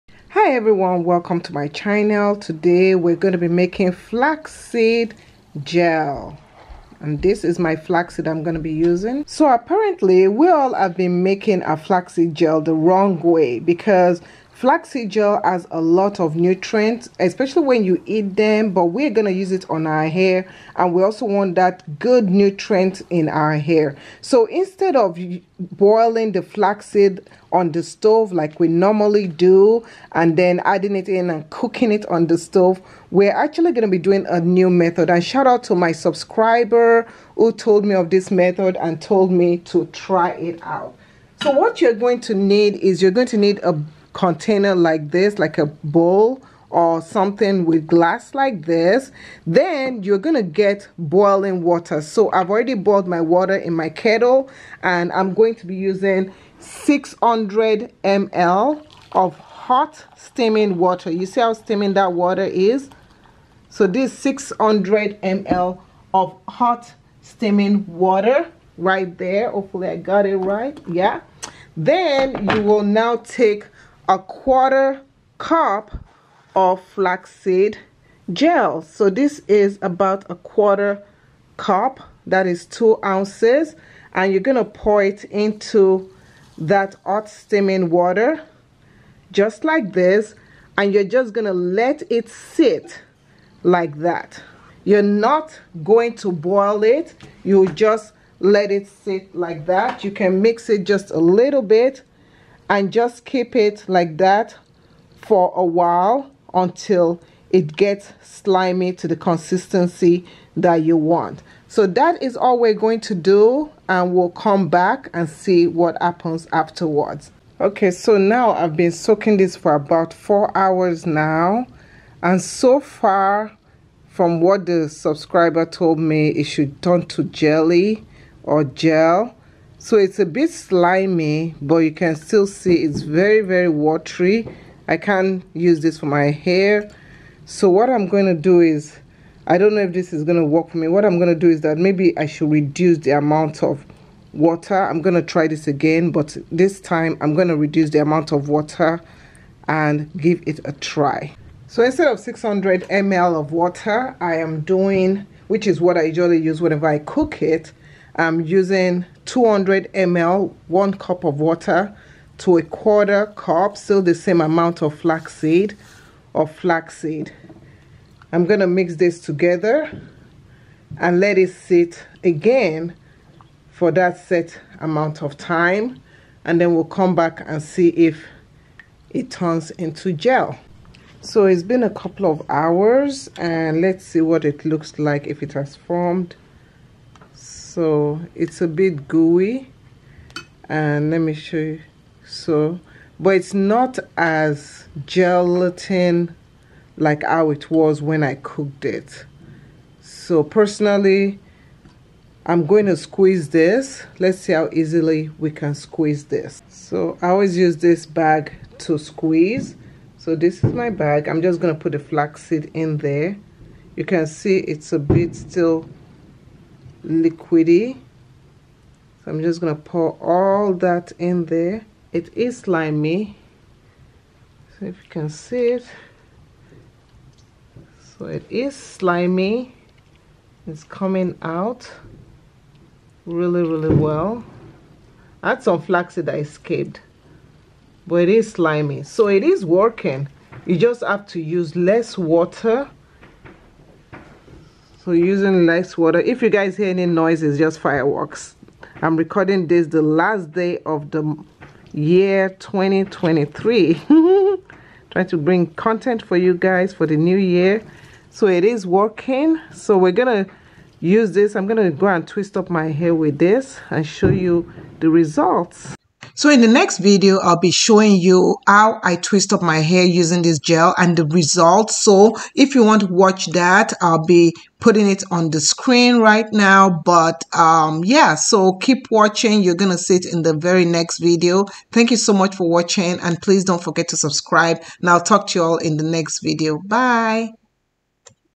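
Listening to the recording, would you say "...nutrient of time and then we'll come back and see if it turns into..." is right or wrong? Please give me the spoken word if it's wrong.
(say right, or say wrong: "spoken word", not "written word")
wrong: "amount", not "nutrient".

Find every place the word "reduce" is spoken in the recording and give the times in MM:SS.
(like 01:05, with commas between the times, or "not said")
02:22, 02:27.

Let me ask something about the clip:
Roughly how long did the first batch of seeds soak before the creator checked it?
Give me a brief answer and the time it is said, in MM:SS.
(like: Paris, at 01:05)
4 hours, at 02:00.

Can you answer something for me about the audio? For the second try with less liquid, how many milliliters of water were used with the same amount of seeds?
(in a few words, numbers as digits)
200 ml.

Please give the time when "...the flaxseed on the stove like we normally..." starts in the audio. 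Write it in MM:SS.
00:26.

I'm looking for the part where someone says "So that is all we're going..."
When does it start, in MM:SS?
01:51.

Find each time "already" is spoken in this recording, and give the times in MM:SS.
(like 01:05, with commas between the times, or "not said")
00:52.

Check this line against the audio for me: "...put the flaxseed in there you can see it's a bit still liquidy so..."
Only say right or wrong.
right.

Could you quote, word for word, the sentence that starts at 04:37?
But um, yeah, so keep watching.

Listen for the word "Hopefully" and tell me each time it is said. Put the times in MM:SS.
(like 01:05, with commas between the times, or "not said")
01:09.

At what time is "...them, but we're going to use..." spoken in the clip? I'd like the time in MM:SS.
00:18.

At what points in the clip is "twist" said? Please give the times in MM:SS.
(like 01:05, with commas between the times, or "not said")
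04:22, 04:29.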